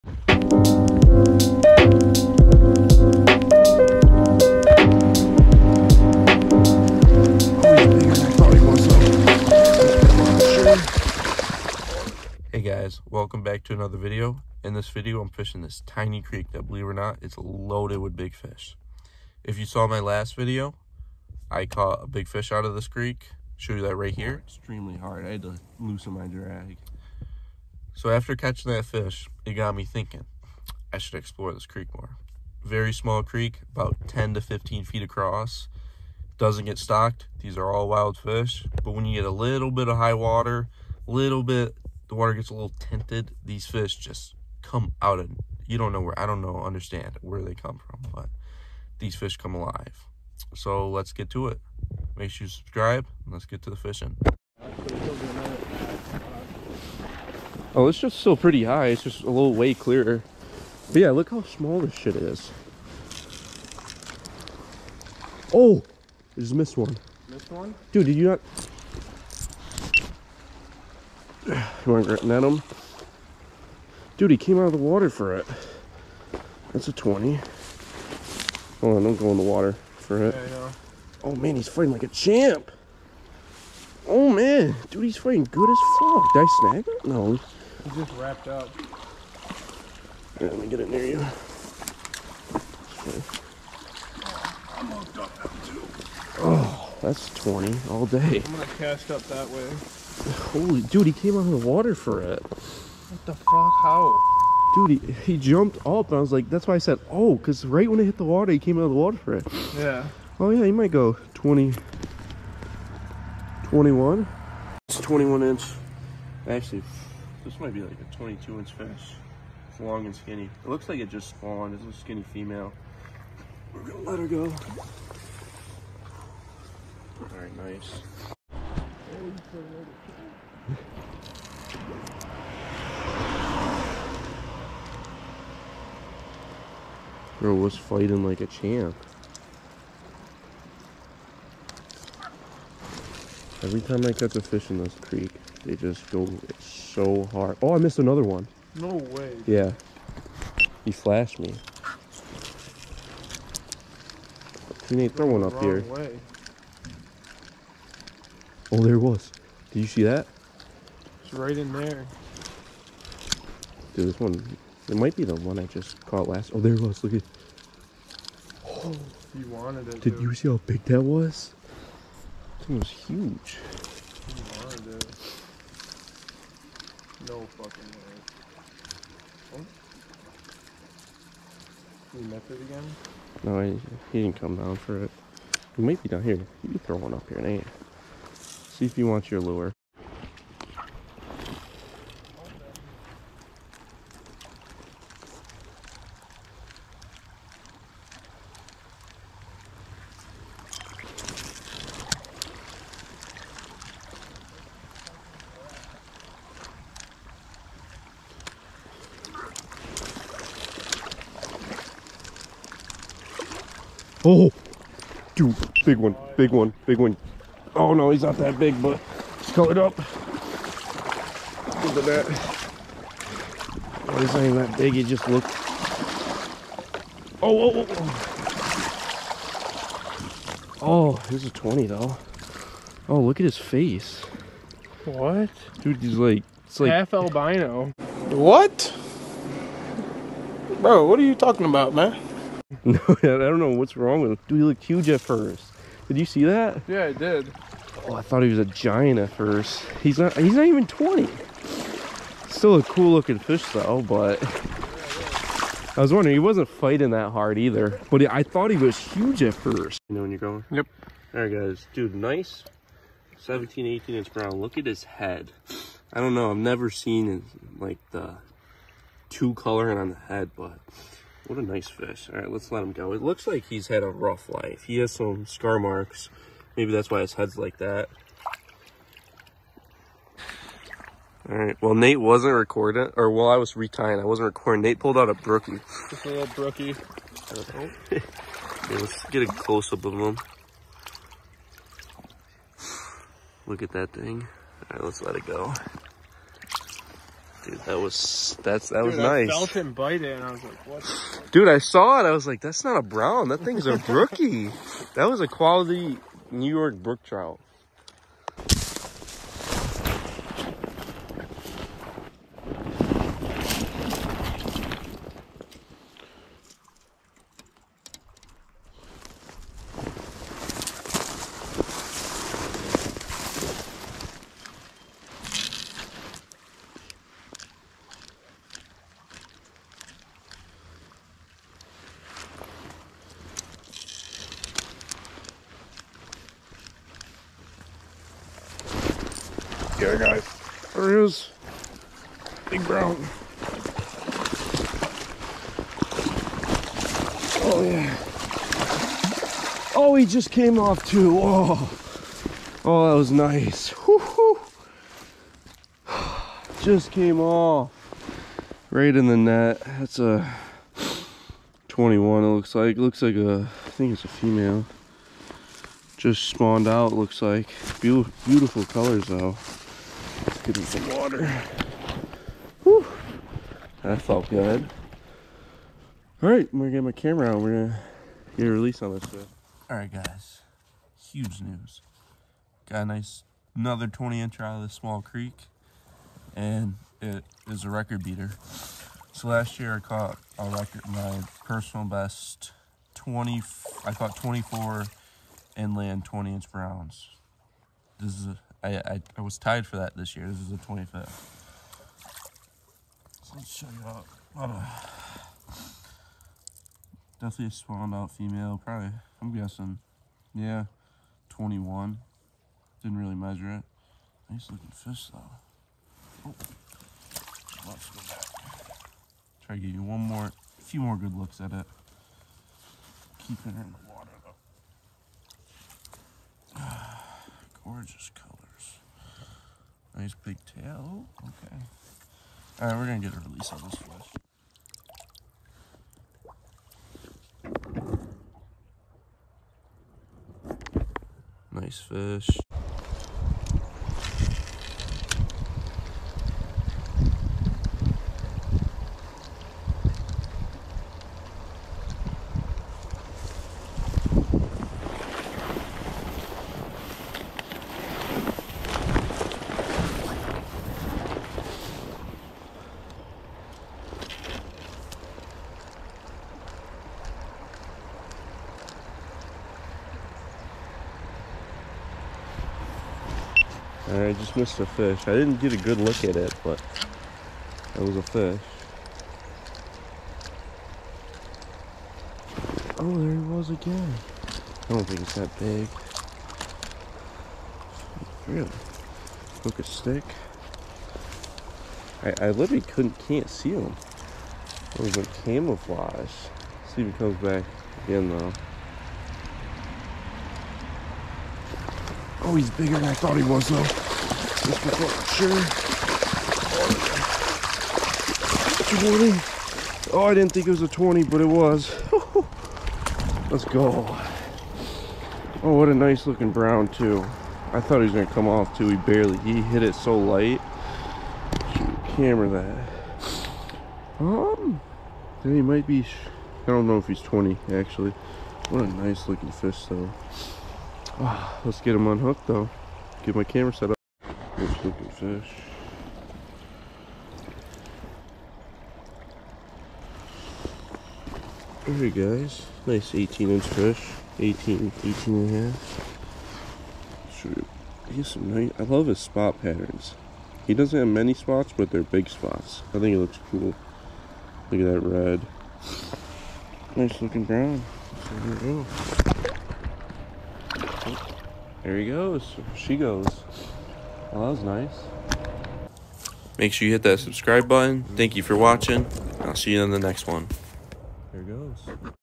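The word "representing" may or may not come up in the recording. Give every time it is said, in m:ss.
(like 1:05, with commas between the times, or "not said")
not said.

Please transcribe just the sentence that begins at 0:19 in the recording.
If you saw my last video, I caught a big fish out of this creek.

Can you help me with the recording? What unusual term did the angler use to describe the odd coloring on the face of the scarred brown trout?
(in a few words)
Half albino.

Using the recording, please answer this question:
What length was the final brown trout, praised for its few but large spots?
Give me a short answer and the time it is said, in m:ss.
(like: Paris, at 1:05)
18 inch, at 9:02.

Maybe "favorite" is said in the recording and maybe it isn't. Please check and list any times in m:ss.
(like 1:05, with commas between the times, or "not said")
not said.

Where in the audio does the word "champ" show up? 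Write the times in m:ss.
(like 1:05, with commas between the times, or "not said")
1:22, 2:18.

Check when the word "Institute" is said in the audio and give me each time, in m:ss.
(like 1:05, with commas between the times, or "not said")
not said.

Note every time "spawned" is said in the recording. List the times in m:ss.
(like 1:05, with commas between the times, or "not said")
2:01, 6:06, 6:47.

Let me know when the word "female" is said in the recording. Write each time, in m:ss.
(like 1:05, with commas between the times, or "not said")
2:02, 6:04, 6:48.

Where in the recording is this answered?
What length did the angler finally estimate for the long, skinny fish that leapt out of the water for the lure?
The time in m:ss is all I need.
1:58.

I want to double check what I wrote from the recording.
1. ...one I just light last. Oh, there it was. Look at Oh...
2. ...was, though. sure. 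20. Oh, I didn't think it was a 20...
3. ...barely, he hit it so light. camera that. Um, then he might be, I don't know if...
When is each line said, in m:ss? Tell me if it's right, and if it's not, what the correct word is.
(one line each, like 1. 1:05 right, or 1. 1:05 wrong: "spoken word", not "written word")
1. 2:45 wrong: "caught", not "light"
2. 8:23 right
3. 8:38 right.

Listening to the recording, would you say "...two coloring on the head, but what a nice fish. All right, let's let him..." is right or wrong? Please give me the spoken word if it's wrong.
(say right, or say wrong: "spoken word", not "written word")
right.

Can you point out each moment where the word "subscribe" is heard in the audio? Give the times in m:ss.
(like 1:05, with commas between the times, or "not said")
0:52, 9:27.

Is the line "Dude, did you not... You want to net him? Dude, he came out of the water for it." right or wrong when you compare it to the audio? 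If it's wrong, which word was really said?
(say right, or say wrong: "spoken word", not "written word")
right.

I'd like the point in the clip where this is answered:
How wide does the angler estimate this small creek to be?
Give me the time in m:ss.
0:33.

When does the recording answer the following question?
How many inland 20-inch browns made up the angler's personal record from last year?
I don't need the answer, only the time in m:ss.
6:34.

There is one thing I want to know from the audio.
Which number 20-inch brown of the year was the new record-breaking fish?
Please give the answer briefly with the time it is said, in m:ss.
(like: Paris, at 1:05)
25th, at 6:40.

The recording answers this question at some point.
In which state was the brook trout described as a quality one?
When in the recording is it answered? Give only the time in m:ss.
5:06.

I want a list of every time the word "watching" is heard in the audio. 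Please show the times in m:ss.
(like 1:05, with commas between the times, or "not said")
9:28.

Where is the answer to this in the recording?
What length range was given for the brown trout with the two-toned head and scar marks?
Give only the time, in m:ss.
4:23.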